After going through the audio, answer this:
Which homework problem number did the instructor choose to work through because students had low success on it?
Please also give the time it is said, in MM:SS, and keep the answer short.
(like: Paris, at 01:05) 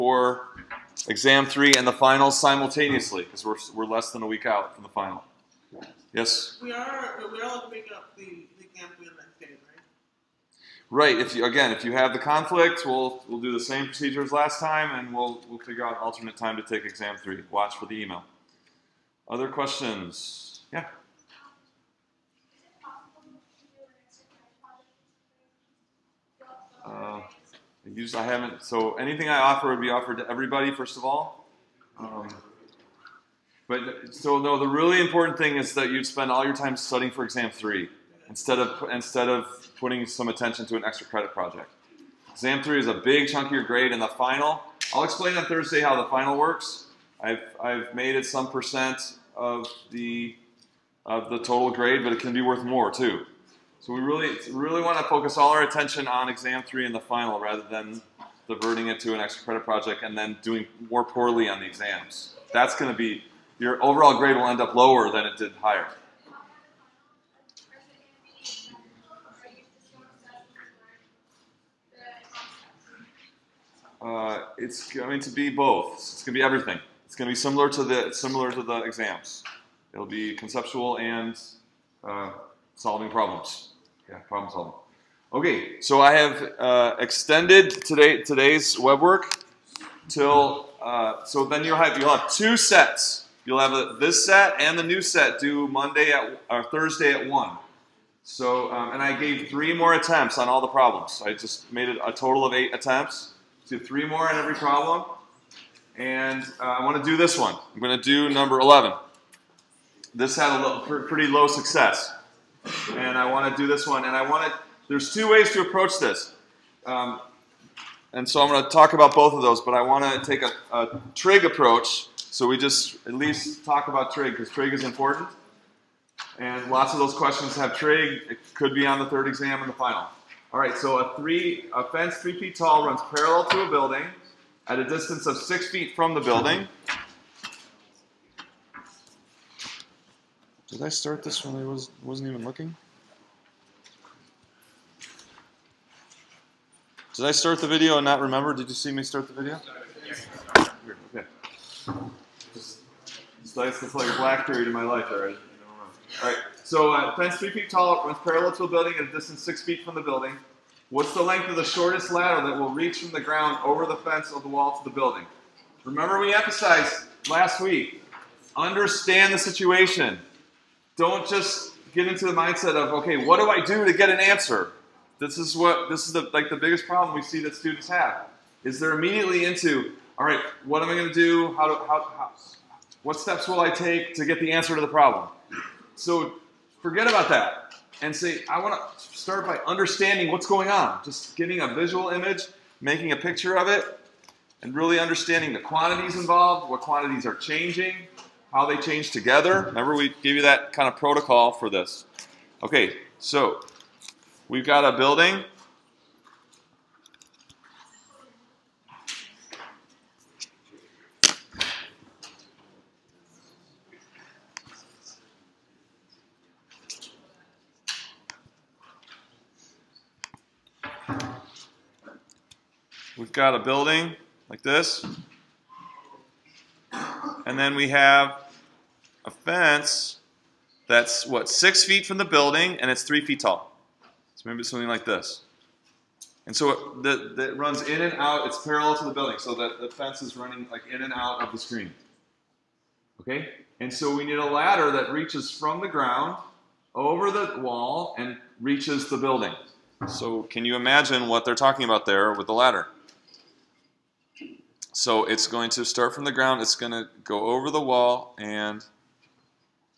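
11, at 01:48.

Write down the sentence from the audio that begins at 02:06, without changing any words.
And lots of those questions have trig.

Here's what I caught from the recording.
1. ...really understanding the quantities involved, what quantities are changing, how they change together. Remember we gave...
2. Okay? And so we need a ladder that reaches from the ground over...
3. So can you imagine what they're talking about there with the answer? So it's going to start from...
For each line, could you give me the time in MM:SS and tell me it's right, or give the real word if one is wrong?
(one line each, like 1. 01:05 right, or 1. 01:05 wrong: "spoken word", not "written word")
1. 03:14 right
2. 04:03 right
3. 04:10 wrong: "ladder", not "answer".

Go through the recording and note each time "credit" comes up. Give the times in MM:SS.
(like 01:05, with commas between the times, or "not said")
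00:41, 00:59.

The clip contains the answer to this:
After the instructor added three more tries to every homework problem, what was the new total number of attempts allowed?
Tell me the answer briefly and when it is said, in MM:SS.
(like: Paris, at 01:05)
8, at 01:42.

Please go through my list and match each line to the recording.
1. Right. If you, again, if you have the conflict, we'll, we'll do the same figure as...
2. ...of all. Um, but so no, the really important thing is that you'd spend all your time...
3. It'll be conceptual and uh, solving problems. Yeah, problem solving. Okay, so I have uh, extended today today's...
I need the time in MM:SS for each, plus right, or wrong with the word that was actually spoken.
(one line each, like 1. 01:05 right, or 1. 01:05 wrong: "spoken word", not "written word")
1. 00:10 wrong: "procedure", not "figure"
2. 00:30 right
3. 01:19 right.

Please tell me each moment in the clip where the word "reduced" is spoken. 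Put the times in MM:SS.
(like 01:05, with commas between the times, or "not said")
not said.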